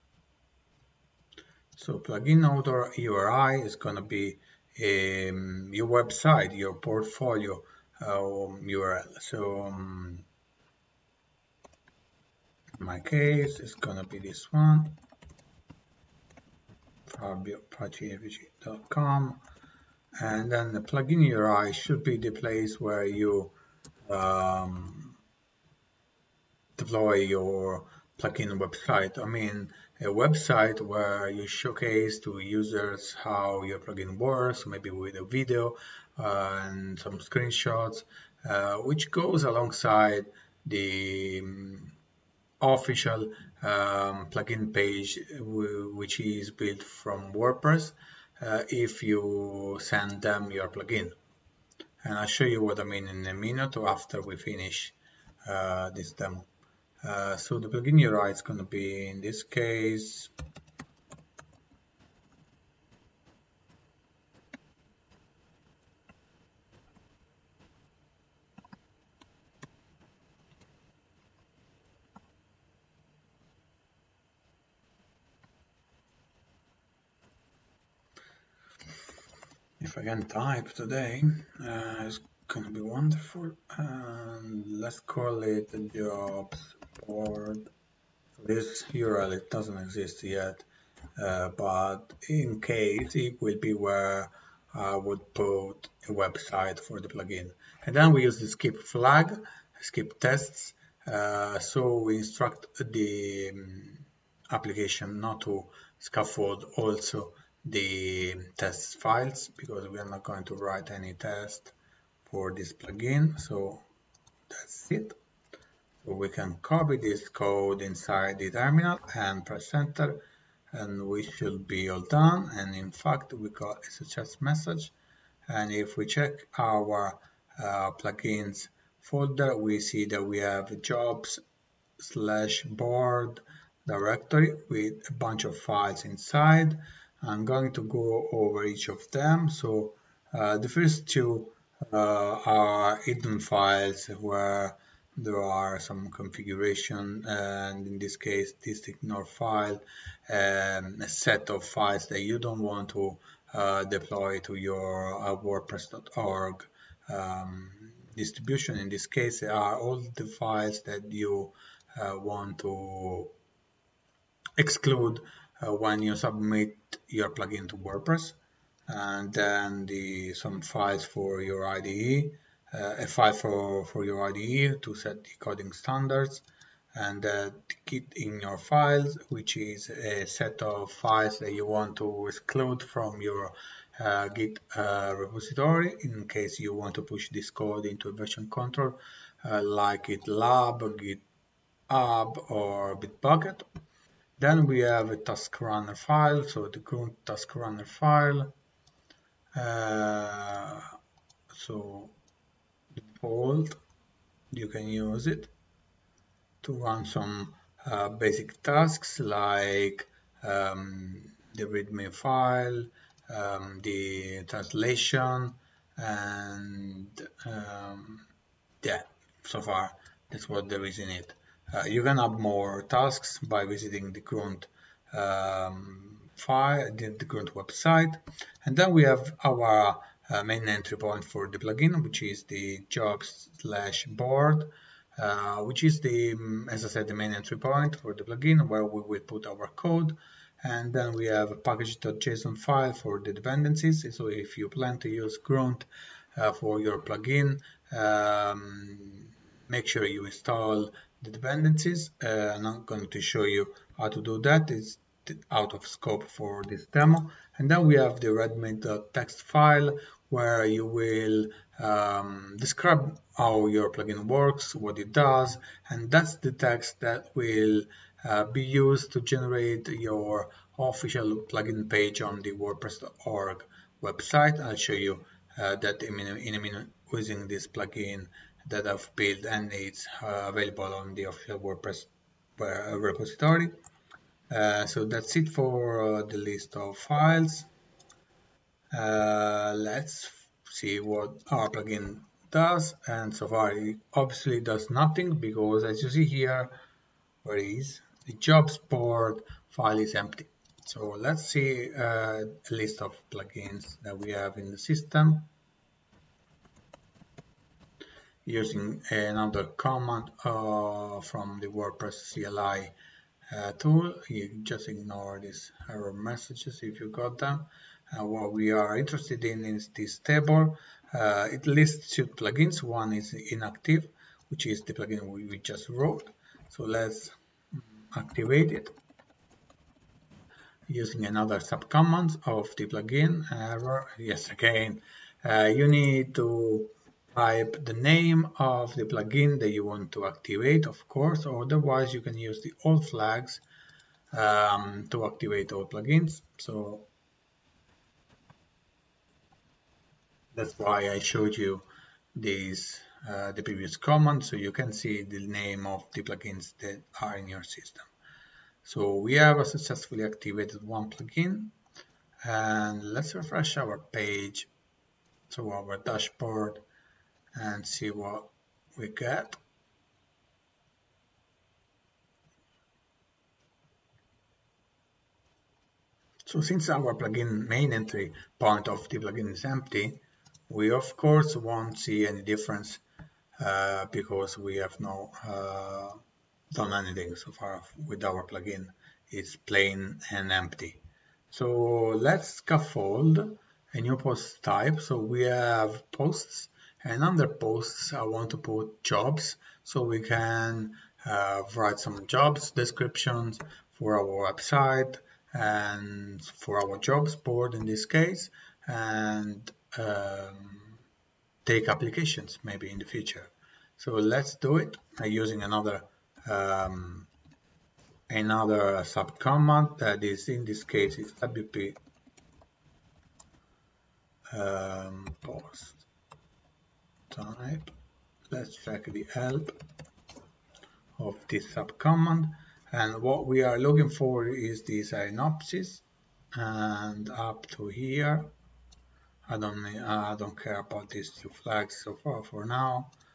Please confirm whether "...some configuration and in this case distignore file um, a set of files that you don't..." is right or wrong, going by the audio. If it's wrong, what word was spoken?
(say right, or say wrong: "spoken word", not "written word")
right.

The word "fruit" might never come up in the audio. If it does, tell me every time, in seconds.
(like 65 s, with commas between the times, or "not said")
not said.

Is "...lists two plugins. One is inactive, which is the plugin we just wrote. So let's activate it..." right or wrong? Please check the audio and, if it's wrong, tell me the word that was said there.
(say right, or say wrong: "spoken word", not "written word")
right.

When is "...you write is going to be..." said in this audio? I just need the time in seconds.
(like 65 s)
57 s.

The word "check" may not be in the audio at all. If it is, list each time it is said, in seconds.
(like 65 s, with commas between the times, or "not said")
126 s, 428 s.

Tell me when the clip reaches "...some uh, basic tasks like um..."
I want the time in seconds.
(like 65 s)
207 s.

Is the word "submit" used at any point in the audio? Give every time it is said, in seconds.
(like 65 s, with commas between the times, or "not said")
166 s.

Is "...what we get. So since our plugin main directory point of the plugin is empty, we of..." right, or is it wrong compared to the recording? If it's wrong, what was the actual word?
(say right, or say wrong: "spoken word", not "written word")
wrong: "entry", not "directory".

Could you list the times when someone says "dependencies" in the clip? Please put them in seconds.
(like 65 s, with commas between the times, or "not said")
243 s, 251 s.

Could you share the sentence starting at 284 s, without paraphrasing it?
Uh, so that's it for uh, the list of files.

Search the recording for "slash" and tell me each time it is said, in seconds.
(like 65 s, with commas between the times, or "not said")
131 s, 233 s.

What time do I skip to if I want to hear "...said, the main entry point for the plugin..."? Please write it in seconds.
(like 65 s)
236 s.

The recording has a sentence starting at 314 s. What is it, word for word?
You just ignore these error messages if you got them.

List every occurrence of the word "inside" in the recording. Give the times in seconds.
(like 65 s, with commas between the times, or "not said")
117 s, 136 s.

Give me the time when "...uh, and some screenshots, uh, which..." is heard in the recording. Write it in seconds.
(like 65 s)
36 s.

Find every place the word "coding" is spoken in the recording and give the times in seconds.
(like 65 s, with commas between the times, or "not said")
175 s.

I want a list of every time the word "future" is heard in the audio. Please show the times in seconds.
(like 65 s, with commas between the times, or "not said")
413 s.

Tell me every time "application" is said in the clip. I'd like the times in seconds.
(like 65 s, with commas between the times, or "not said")
104 s, 411 s.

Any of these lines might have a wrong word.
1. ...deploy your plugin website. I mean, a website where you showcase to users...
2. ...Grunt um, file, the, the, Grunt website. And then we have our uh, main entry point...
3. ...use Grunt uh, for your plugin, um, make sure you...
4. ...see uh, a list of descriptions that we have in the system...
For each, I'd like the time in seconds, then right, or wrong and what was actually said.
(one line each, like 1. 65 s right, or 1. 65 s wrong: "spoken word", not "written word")
1. 26 s right
2. 224 s right
3. 245 s right
4. 301 s wrong: "plugins", not "descriptions".